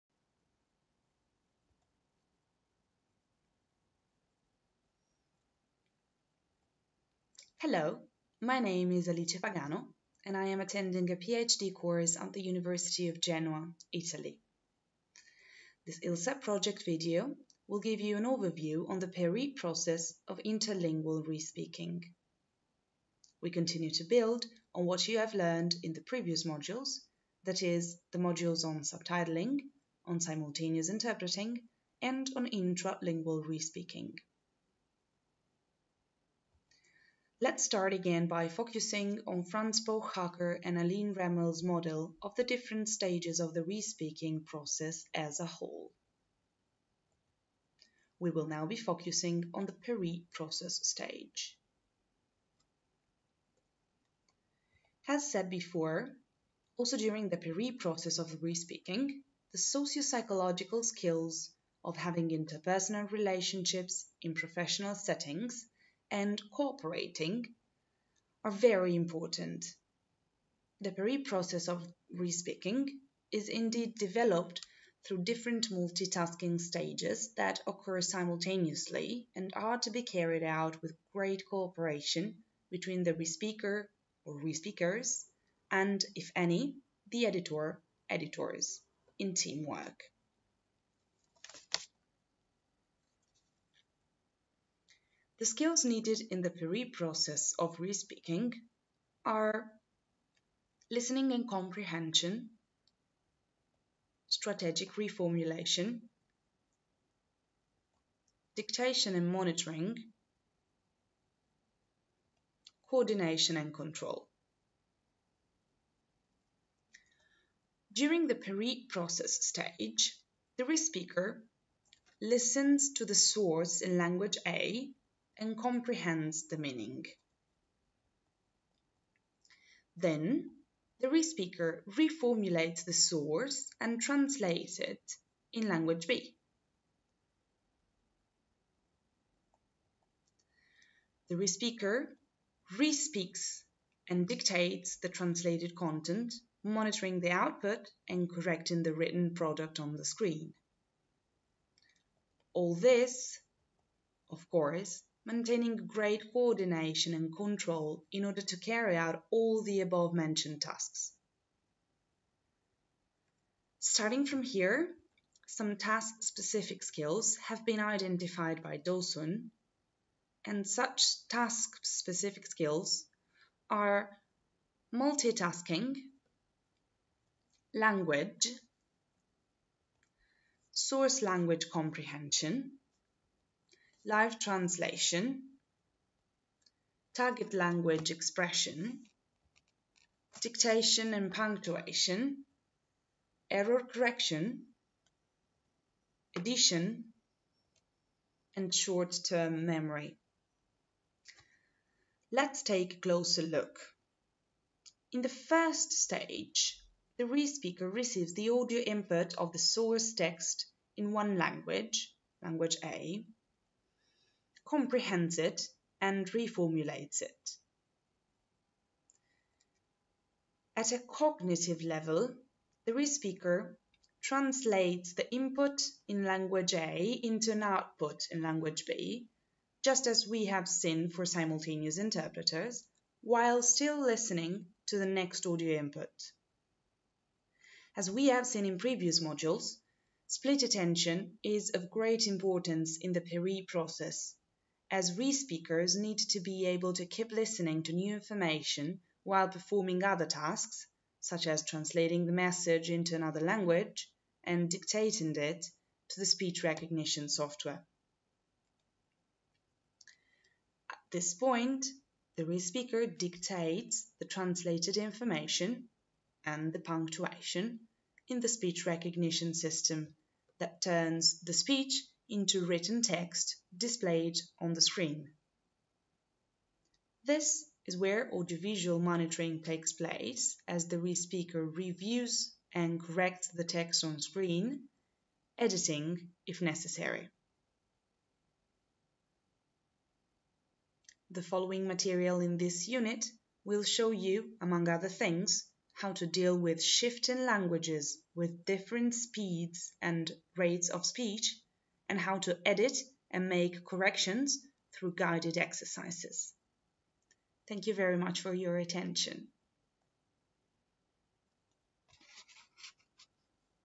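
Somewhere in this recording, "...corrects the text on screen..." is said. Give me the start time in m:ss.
4:43.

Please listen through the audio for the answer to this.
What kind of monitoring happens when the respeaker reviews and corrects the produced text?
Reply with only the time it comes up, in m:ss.
4:38.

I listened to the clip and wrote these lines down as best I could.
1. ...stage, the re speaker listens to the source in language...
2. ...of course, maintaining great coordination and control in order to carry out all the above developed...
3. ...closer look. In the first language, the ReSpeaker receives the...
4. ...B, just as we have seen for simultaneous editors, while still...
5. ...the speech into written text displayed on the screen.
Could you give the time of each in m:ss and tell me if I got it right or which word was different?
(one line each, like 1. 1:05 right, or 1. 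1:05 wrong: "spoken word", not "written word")
1. 1:59 right
2. 2:34 wrong: "mentioned", not "developed"
3. 3:23 wrong: "stage", not "language"
4. 3:48 wrong: "interpreters", not "editors"
5. 4:31 right.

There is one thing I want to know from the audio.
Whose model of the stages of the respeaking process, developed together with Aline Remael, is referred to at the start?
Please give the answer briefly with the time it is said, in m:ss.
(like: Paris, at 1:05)
Franz Pöchhacker, at 0:39.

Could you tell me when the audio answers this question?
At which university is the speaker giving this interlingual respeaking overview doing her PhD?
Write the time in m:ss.
0:12.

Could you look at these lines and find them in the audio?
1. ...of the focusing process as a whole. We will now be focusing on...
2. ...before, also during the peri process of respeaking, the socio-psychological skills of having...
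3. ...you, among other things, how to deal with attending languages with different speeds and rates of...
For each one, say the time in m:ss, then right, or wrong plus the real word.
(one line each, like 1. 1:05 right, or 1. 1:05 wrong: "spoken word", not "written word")
1. 0:43 wrong: "respeaking", not "focusing"
2. 0:55 right
3. 4:54 wrong: "shifting", not "attending".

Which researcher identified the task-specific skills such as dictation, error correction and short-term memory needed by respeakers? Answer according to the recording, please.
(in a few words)
Dawson.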